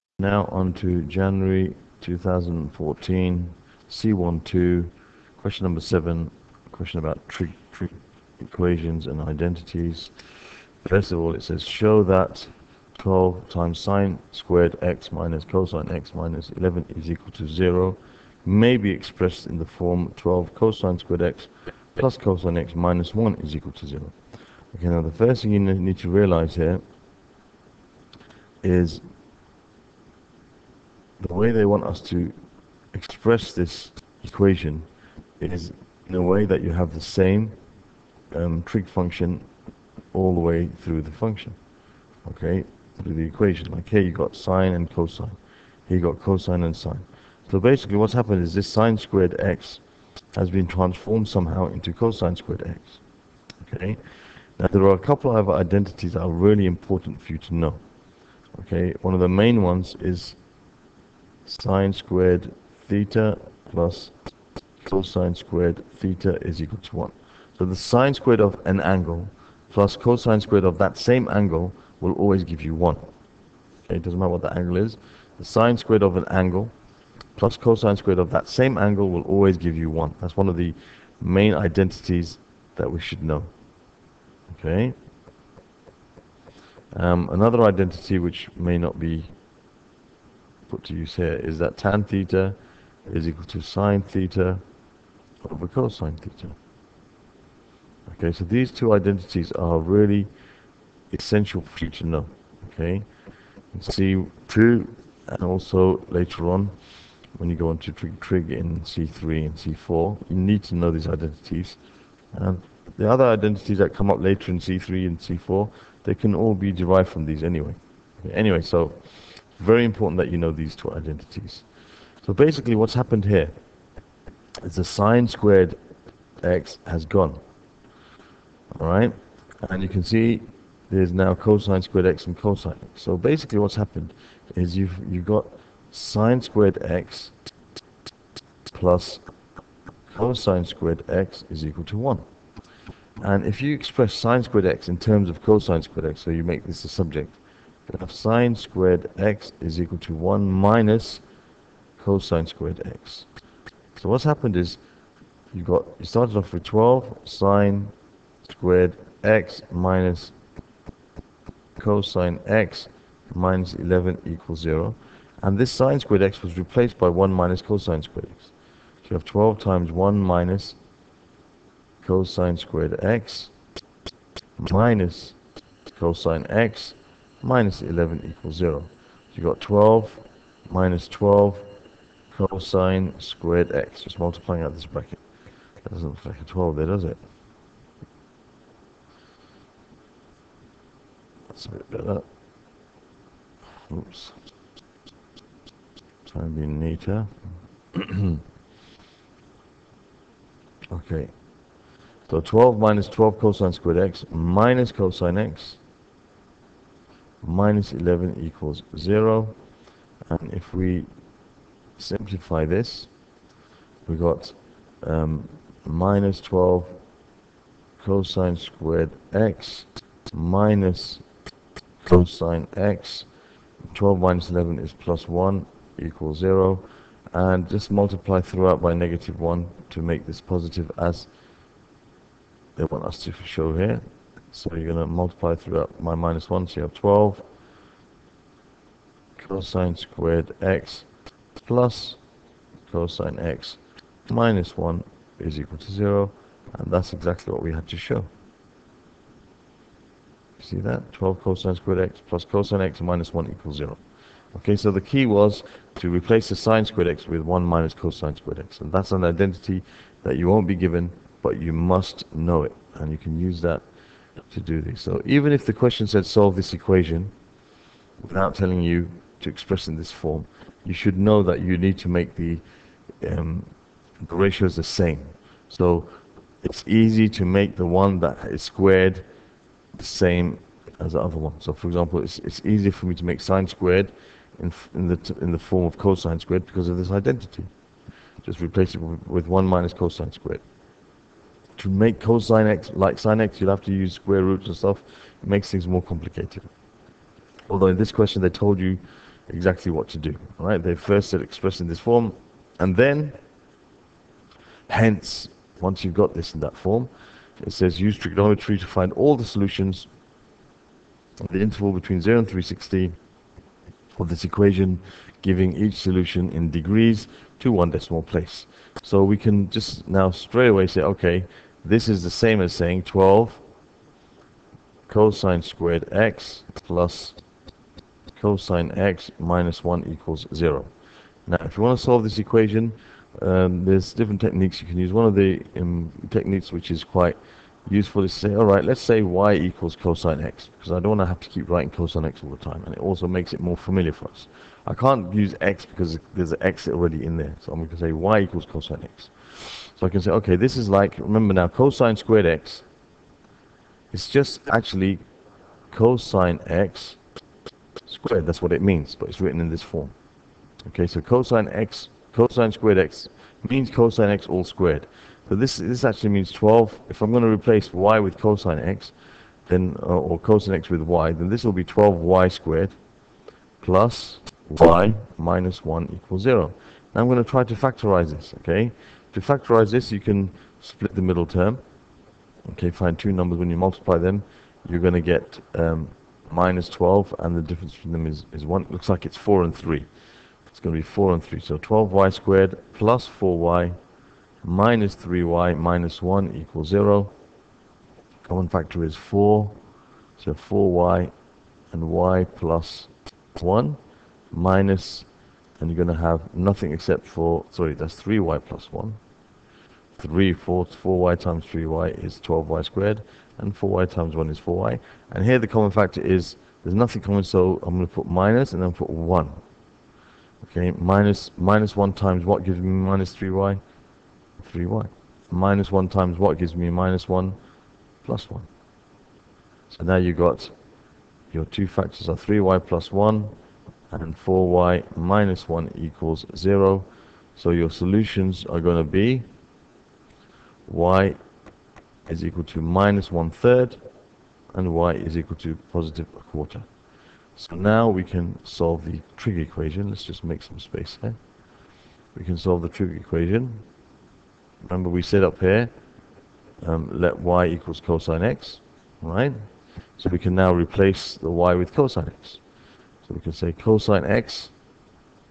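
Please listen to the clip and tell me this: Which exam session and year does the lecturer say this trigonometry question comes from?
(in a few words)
January 2014.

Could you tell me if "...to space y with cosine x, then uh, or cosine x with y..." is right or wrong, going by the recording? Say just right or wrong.
wrong.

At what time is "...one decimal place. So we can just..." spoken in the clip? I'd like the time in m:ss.
5:17.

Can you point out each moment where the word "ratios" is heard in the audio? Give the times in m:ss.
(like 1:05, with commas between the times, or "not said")
4:34.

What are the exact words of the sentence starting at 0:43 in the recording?
Like here you got sine and cosine, here you got cosine and sine.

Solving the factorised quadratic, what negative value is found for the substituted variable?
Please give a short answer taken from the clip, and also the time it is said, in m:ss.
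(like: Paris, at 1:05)
-1/3, at 7:22.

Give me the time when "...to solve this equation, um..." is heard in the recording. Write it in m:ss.
5:31.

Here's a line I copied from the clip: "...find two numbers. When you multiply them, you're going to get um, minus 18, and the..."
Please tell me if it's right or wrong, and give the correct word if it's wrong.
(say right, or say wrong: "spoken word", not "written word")
wrong: "12", not "18".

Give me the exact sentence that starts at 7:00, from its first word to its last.
Okay, minus, minus 1 times what gives me minus 3y?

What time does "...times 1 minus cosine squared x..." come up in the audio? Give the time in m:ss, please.
2:49.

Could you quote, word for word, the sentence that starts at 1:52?
And the other identities that come up later in C3 and C4, they can all be derived from these anyway.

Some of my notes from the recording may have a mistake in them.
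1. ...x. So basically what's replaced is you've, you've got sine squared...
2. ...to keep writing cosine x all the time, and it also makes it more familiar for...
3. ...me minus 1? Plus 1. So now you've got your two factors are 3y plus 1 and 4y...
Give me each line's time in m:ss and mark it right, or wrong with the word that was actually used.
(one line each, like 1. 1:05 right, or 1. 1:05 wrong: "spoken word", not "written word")
1. 2:12 wrong: "happened", not "replaced"
2. 5:41 right
3. 7:06 right.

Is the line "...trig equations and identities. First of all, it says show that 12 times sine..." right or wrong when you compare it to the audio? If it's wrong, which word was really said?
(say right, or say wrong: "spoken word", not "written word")
right.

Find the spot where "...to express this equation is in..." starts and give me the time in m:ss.
0:31.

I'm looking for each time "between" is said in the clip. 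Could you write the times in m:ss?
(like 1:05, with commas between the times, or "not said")
5:11, 6:27.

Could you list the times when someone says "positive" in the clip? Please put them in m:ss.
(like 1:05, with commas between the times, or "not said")
3:50, 7:25.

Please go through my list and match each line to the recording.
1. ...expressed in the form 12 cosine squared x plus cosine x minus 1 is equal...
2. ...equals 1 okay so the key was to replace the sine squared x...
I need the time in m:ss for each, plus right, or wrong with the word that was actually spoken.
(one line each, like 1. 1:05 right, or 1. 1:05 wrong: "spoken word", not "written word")
1. 0:18 right
2. 4:13 wrong: "0", not "1".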